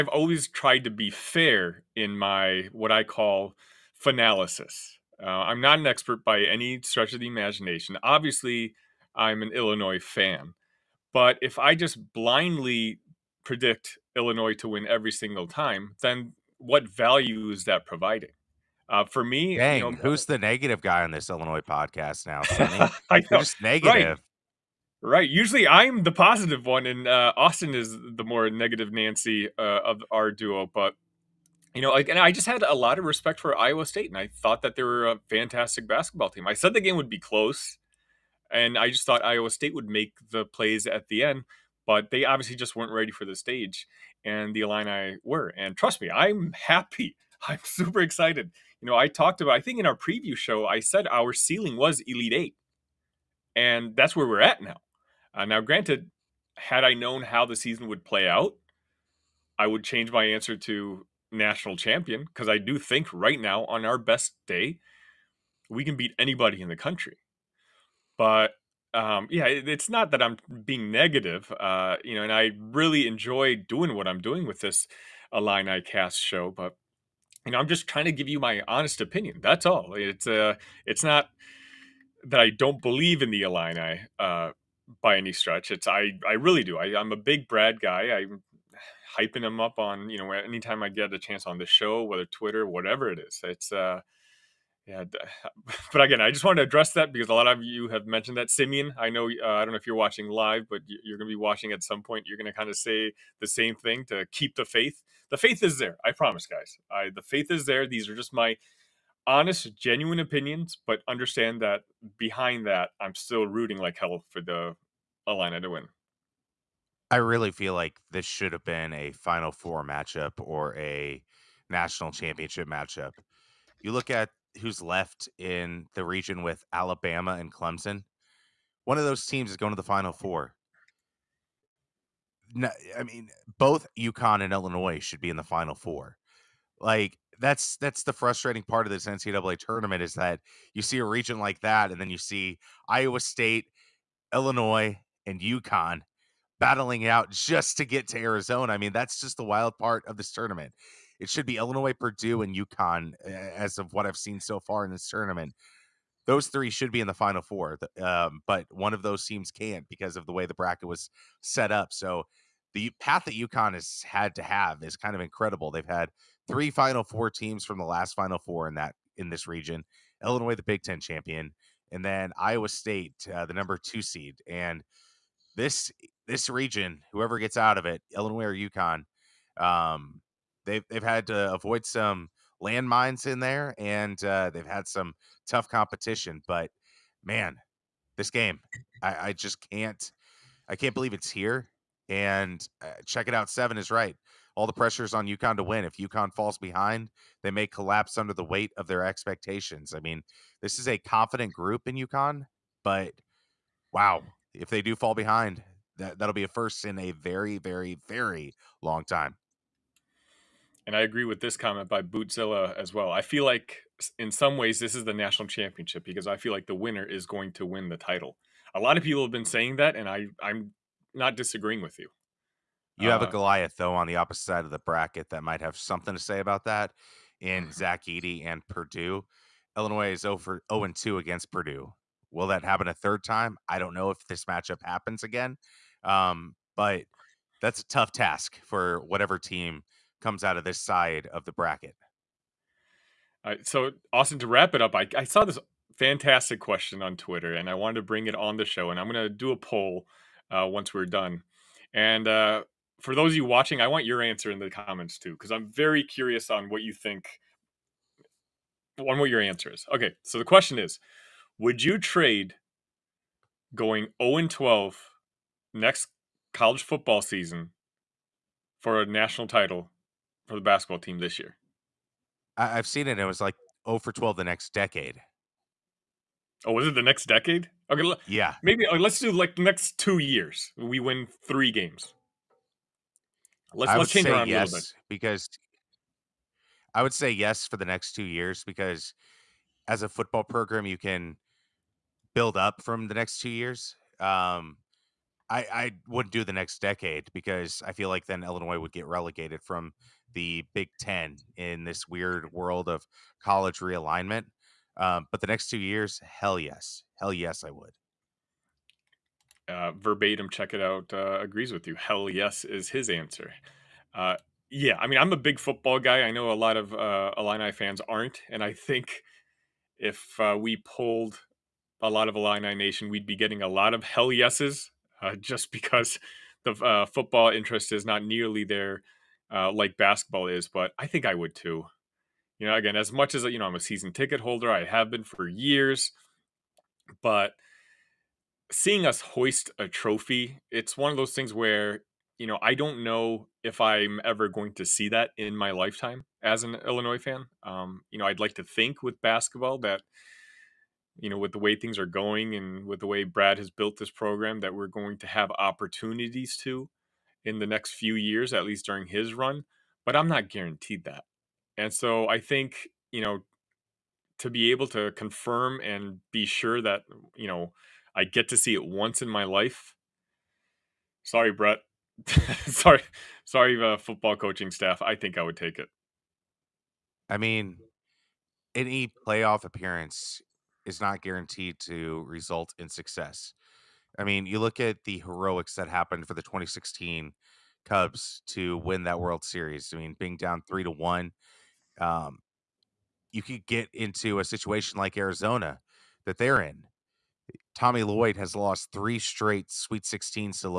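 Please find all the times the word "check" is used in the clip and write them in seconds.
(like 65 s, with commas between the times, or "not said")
193 s, 310 s.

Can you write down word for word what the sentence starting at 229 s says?
Illinois is over 0 and 2 against Purdue.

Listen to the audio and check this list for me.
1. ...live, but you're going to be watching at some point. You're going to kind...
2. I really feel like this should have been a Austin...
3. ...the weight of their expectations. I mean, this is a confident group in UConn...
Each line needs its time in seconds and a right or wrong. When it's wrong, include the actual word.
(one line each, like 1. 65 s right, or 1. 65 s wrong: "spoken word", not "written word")
1. 100 s right
2. 117 s wrong: "Final", not "Austin"
3. 198 s right.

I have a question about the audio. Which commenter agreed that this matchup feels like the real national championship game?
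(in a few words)
Bootzilla.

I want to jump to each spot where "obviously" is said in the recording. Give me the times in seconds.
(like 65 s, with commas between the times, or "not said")
8 s, 42 s.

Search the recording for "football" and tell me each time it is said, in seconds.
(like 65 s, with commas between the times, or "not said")
266 s, 290 s, 315 s, 327 s, 373 s.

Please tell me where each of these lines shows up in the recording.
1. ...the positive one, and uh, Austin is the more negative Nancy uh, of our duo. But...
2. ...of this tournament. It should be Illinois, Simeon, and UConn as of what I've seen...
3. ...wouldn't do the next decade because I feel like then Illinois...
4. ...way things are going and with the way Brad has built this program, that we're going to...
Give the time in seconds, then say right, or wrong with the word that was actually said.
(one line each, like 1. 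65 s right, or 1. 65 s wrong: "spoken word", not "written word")
1. 26 s right
2. 150 s wrong: "Purdue", not "Simeon"
3. 296 s right
4. 351 s right.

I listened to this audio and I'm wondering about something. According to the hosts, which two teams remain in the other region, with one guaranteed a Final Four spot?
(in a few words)
Alabama and Clemson.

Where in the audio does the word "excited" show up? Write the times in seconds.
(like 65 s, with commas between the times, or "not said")
48 s.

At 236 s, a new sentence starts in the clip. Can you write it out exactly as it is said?
Um, but that's a tough task for whatever team comes out of this side of the bracket.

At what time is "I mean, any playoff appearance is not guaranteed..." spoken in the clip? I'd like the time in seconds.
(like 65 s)
377 s.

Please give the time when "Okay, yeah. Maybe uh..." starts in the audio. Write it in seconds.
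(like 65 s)
277 s.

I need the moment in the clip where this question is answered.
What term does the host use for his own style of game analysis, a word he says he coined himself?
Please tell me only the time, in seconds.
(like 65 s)
4 s.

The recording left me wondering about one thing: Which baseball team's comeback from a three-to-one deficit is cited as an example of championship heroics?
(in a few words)
2016 Cubs.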